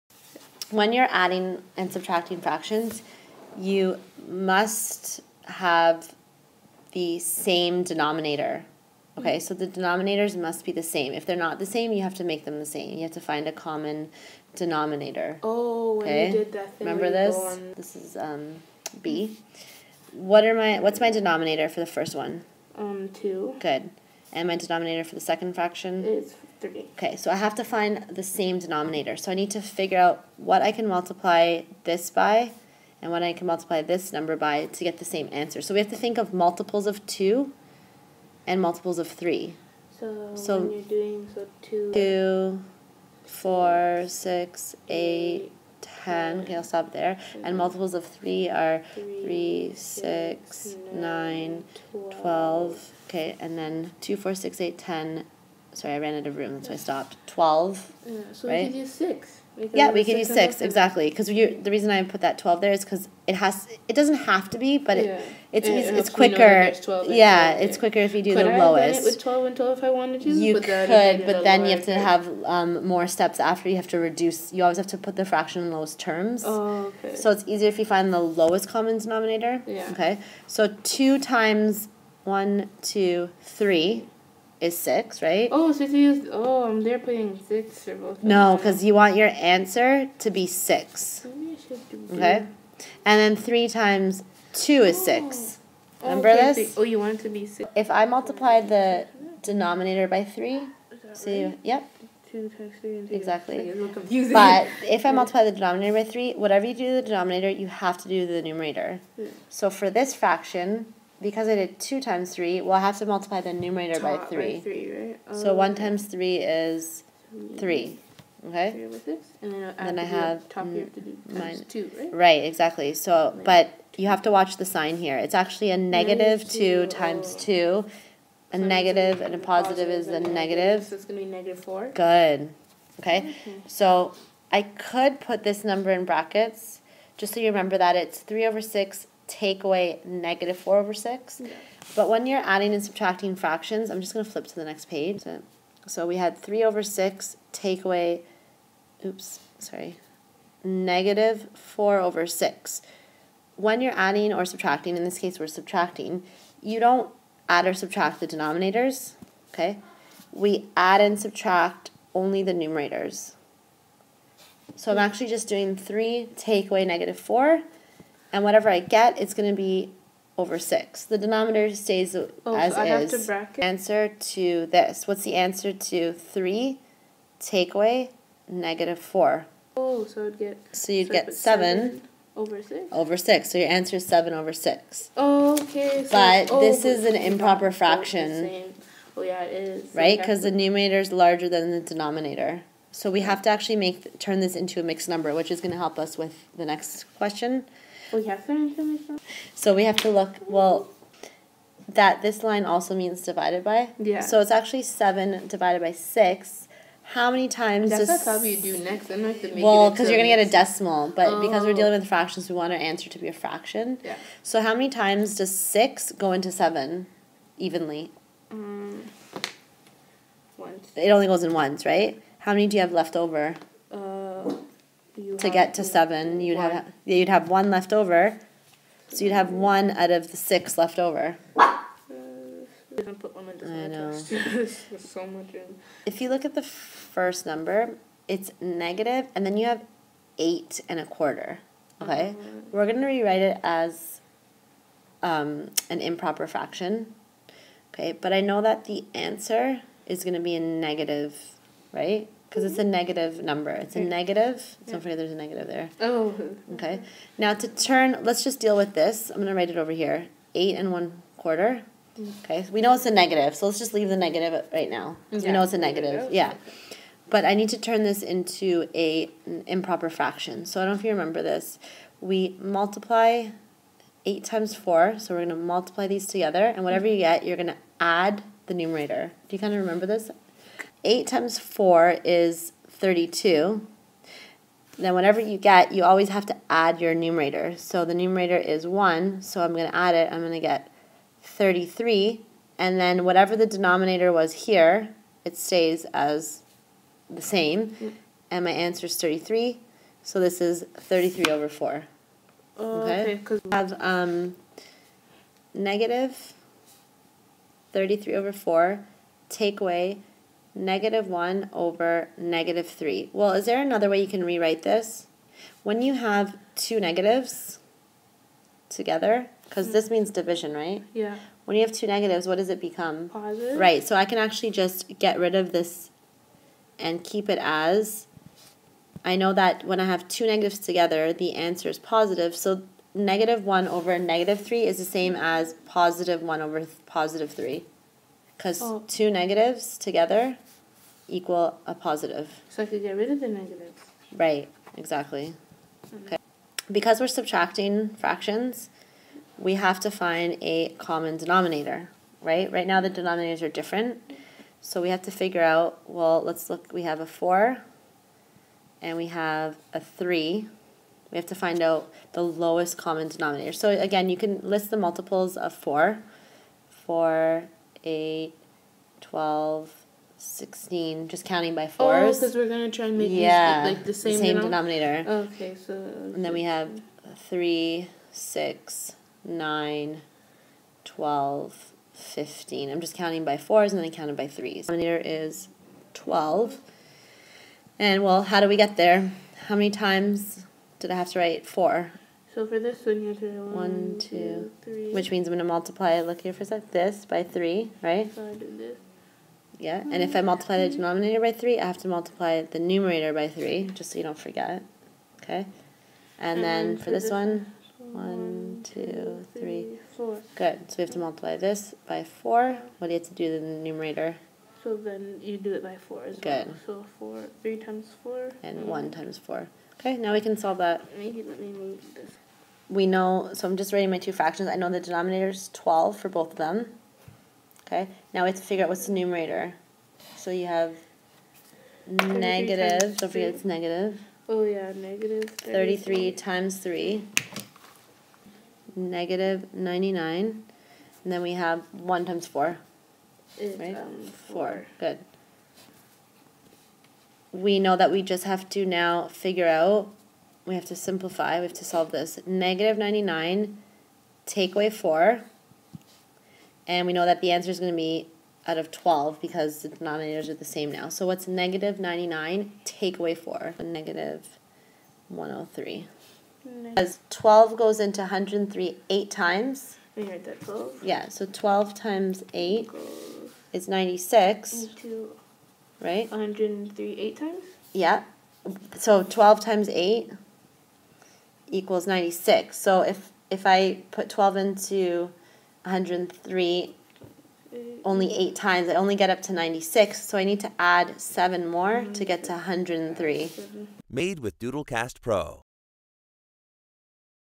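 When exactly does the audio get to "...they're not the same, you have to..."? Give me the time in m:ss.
0:11.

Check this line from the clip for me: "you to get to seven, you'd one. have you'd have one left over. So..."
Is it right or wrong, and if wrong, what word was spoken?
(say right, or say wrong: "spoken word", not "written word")
right.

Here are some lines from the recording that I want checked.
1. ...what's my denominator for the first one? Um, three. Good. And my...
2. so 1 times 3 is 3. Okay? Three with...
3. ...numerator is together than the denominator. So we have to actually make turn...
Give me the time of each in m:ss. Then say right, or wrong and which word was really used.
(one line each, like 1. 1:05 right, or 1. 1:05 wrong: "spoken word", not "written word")
1. 0:20 wrong: "two", not "three"
2. 1:55 right
3. 3:10 wrong: "larger", not "together".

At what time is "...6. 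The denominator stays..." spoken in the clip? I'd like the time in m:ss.
2:50.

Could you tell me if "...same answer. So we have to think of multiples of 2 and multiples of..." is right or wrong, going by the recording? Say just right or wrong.
right.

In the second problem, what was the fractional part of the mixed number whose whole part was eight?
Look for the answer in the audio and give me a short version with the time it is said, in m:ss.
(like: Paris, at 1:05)
a quarter, at 4:00.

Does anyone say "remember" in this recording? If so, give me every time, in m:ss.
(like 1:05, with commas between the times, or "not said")
0:16, 1:36, 2:17, 4:31, 4:39.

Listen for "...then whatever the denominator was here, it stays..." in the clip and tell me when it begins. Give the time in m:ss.
4:52.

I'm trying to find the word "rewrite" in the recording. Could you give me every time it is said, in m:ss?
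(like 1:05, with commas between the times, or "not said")
4:03, 5:14.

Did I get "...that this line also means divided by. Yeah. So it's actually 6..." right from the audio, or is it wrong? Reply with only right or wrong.
wrong.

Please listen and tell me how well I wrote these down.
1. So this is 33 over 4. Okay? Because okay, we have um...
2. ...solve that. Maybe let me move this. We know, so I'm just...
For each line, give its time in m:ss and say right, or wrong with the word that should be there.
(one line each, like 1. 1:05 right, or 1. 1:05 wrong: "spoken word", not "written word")
1. 5:00 right
2. 7:00 right.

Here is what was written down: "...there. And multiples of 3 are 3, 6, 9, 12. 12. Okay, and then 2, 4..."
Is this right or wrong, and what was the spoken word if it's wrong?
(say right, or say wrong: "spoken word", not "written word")
right.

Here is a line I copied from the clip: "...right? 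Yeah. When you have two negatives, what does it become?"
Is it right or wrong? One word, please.
right.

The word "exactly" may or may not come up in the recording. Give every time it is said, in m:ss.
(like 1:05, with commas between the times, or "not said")
1:00, 1:43, 2:02, 5:44.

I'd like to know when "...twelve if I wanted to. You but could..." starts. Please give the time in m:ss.
1:09.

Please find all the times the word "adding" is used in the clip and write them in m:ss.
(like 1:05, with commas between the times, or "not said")
0:01, 2:22, 2:33.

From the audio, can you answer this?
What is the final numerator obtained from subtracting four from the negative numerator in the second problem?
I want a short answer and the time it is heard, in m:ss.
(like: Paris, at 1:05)
-103, at 7:43.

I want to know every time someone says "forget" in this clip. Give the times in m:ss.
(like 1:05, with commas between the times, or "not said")
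4:15, 6:44, 7:13.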